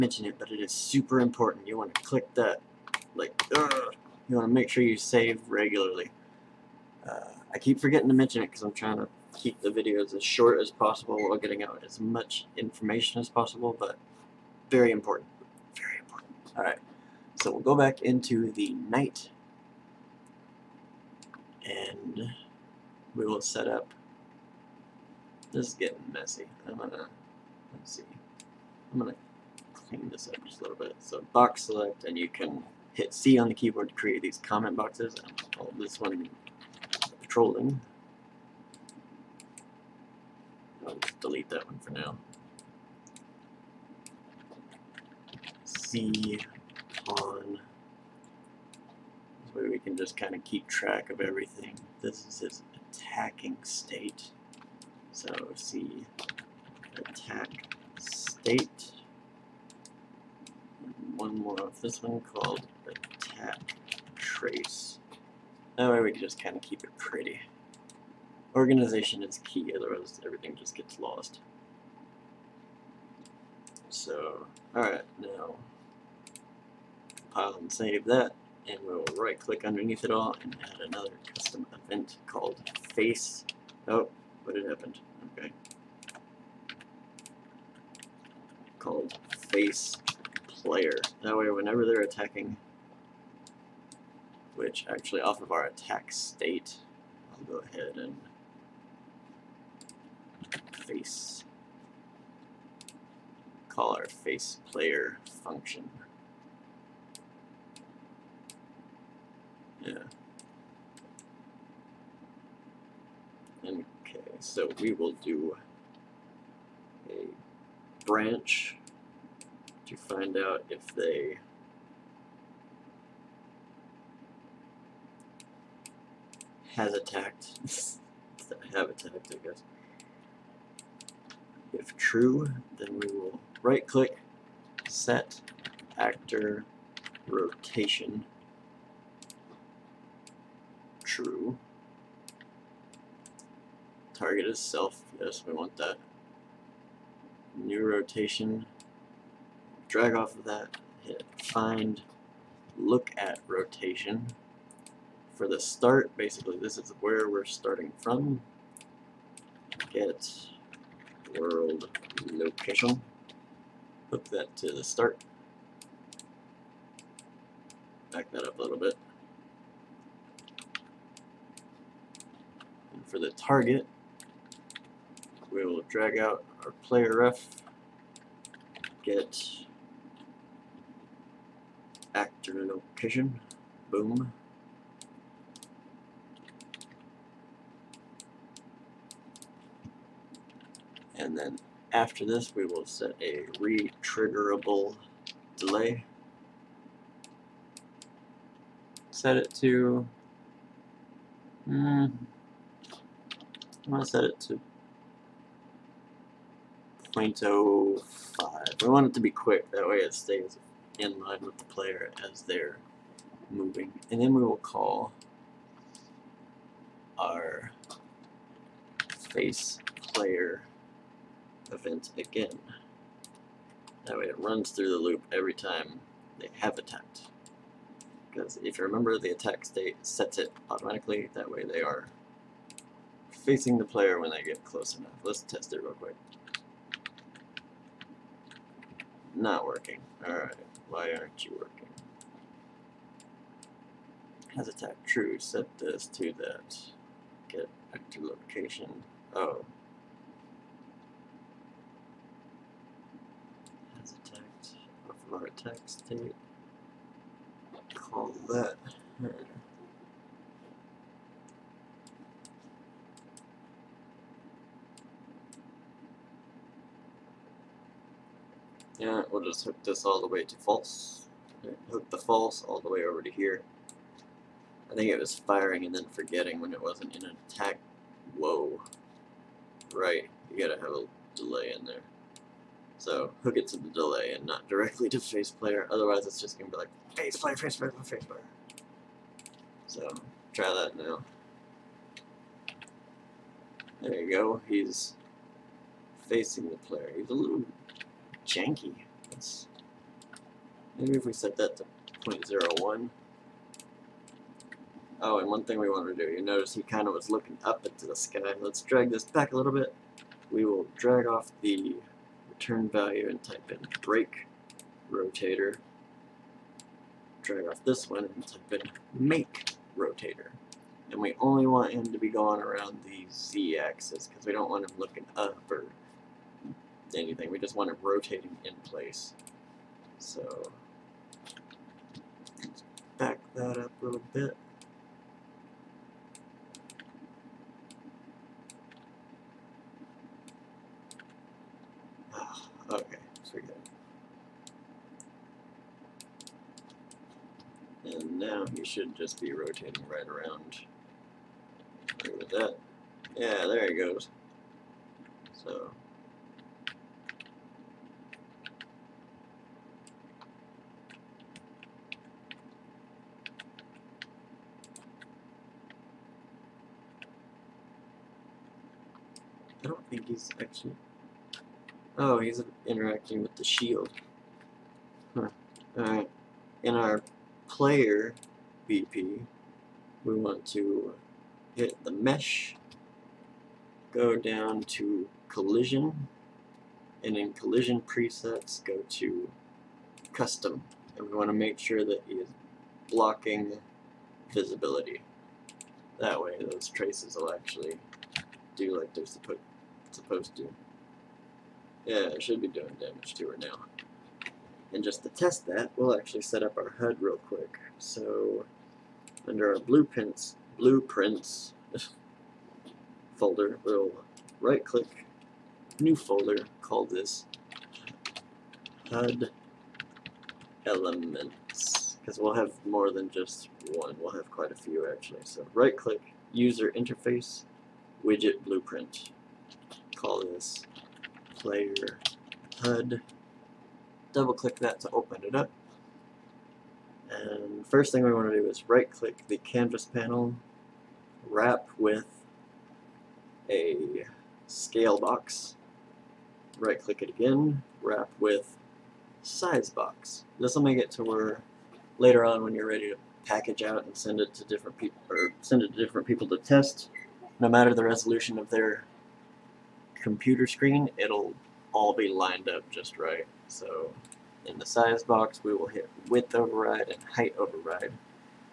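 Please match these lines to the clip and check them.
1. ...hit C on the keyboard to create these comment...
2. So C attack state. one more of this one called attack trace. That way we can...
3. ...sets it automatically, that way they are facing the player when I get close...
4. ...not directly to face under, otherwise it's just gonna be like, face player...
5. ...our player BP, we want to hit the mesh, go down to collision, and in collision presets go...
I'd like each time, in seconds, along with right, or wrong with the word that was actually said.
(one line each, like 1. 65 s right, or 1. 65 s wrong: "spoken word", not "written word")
1. 32 s right
2. 55 s right
3. 230 s right
4. 284 s wrong: "player", not "under"
5. 376 s right.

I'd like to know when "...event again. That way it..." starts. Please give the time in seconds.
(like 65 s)
221 s.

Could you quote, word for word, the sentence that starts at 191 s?
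And then after this we will set a re-triggerable delay.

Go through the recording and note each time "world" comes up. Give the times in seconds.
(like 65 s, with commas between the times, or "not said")
161 s.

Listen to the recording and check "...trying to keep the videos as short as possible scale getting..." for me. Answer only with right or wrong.
wrong.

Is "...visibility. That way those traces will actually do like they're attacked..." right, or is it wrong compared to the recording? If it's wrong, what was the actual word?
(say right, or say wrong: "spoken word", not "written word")
wrong: "supposed", not "attacked".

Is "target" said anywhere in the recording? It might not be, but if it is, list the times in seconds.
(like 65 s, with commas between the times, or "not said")
144 s, 173 s.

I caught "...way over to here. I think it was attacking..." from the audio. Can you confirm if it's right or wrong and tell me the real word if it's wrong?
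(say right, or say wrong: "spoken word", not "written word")
wrong: "firing", not "attacking".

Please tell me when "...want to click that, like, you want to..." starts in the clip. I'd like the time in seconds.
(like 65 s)
1 s.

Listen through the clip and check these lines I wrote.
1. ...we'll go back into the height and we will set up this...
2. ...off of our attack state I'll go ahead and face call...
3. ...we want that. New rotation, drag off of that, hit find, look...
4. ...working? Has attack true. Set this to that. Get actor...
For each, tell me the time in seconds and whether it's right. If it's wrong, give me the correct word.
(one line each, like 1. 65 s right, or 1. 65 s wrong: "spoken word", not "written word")
1. 17 s wrong: "knight", not "height"
2. 95 s right
3. 145 s right
4. 241 s right.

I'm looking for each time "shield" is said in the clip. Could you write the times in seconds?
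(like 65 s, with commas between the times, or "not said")
373 s.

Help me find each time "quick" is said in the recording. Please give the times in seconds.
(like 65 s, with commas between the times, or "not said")
209 s, 235 s, 407 s.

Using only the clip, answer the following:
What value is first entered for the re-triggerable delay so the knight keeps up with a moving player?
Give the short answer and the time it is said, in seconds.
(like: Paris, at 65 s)
0.05, at 207 s.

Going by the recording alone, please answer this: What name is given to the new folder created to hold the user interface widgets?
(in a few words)
HUD elements.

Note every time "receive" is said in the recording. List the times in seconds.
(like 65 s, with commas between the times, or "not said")
not said.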